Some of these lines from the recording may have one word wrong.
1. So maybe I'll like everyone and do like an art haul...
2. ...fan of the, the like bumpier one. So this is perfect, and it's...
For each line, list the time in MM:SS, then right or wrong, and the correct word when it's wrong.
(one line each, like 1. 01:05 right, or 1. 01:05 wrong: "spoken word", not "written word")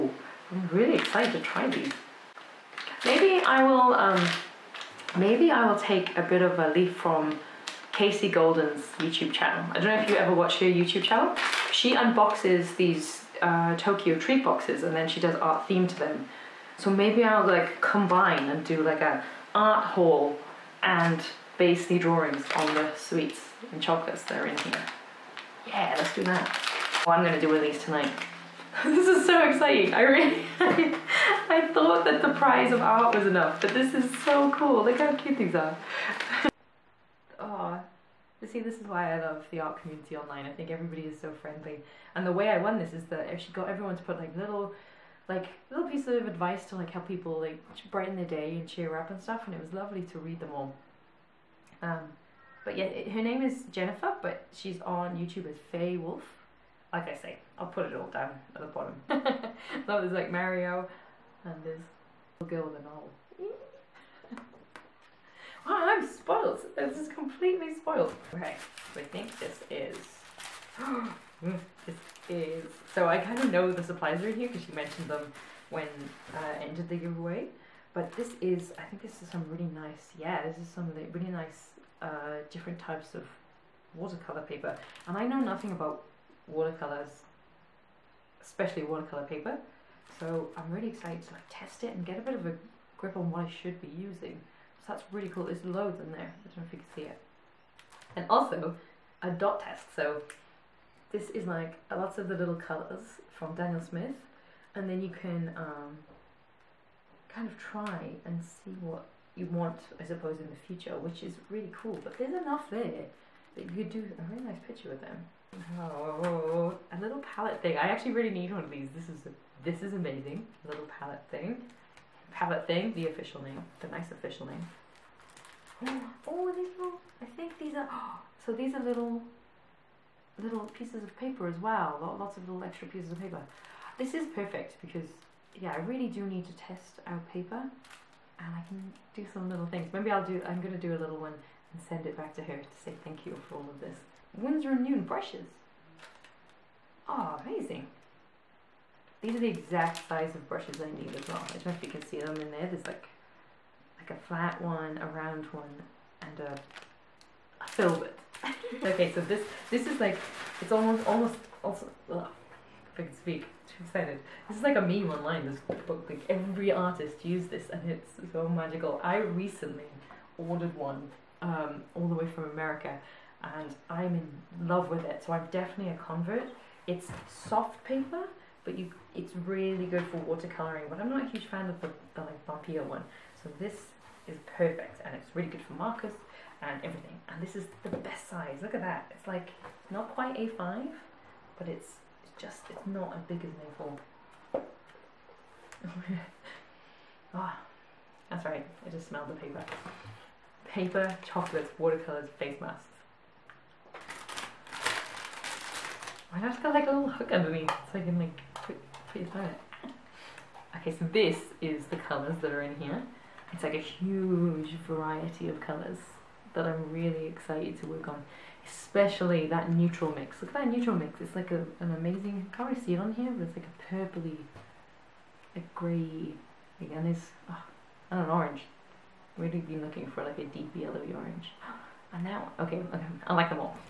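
1. 00:16 wrong: "combine", not "everyone"
2. 03:01 right.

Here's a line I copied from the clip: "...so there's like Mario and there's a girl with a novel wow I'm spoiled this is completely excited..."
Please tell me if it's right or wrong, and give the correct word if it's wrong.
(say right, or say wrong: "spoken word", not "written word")
wrong: "spoiled", not "excited".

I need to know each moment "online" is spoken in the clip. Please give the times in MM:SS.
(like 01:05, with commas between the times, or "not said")
00:40, 02:45.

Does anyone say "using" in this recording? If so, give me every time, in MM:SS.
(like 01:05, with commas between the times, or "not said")
01:33.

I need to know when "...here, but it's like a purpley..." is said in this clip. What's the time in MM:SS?
03:43.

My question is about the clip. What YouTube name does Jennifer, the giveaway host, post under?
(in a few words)
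Faye Wulf.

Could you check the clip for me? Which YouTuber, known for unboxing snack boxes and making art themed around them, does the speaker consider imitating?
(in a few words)
Kasey Golden.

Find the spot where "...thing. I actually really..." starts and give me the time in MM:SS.
01:57.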